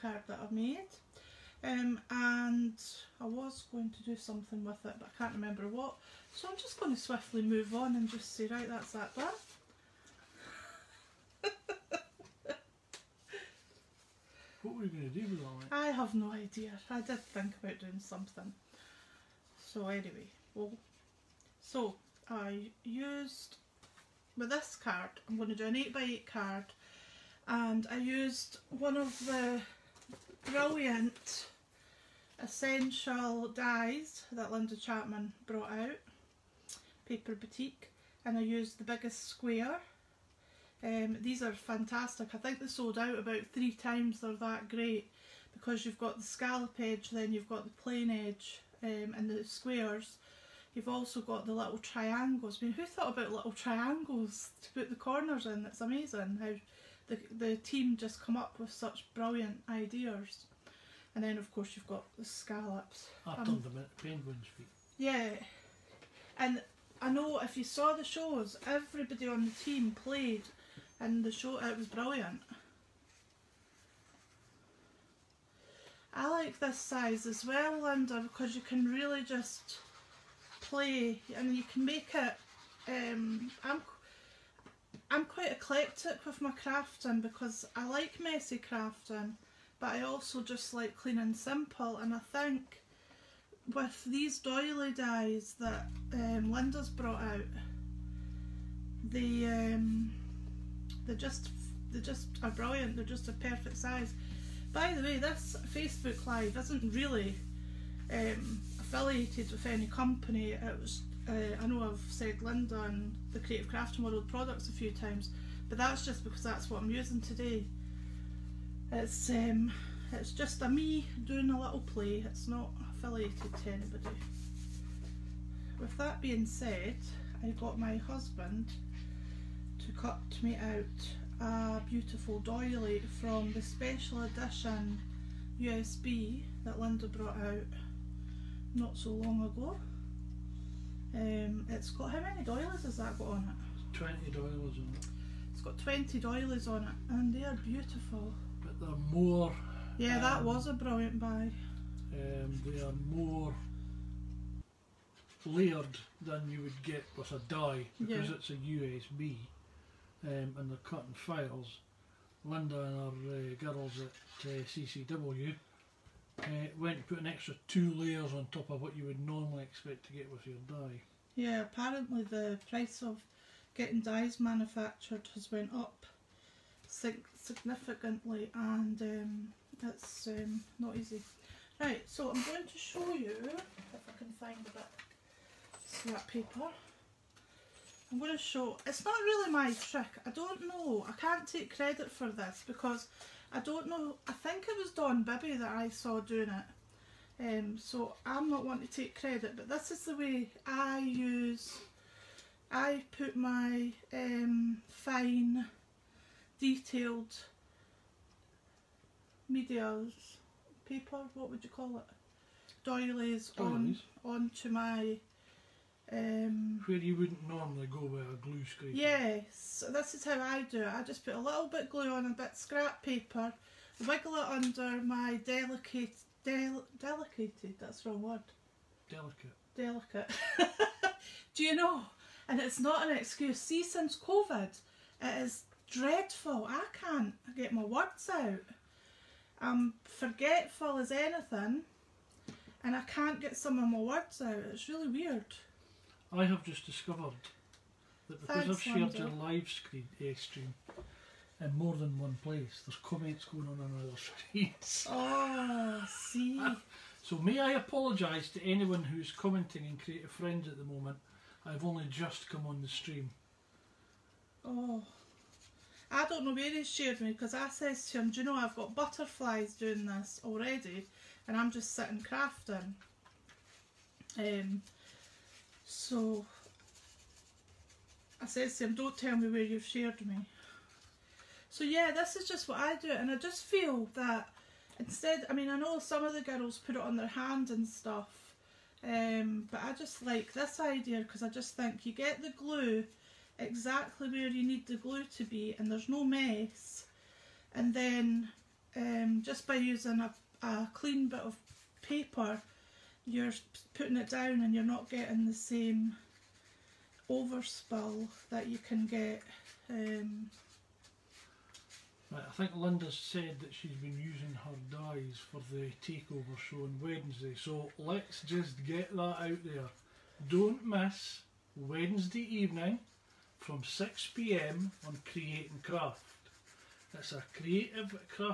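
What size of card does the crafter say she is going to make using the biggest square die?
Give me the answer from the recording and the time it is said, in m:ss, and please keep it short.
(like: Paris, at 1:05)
8x8, at 0:25.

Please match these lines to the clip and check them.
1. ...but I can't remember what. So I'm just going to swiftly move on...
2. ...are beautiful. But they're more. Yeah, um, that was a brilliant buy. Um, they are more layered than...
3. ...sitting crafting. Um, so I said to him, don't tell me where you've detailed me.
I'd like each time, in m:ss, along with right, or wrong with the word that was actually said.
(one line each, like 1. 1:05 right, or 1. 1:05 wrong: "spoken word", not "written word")
1. 0:04 right
2. 2:27 right
3. 4:31 wrong: "shared", not "detailed".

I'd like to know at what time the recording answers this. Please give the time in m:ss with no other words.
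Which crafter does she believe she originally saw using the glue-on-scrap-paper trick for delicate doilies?
3:14.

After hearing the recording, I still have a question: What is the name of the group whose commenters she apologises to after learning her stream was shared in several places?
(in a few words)
Creative Friends.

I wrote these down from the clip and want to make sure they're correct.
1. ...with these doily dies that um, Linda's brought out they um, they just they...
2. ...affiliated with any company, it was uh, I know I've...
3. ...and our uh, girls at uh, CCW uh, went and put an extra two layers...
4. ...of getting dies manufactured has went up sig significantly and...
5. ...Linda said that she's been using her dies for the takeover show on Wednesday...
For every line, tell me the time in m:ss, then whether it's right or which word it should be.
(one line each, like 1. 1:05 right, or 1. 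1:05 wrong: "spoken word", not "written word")
1. 1:33 right
2. 1:48 right
3. 2:42 right
4. 2:53 right
5. 5:12 right.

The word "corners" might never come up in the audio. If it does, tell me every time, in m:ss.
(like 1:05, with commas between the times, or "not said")
0:54.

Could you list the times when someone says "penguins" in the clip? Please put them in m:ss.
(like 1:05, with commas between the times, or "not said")
1:03.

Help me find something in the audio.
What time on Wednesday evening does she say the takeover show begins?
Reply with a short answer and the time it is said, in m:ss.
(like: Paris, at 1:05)
6pm, at 5:23.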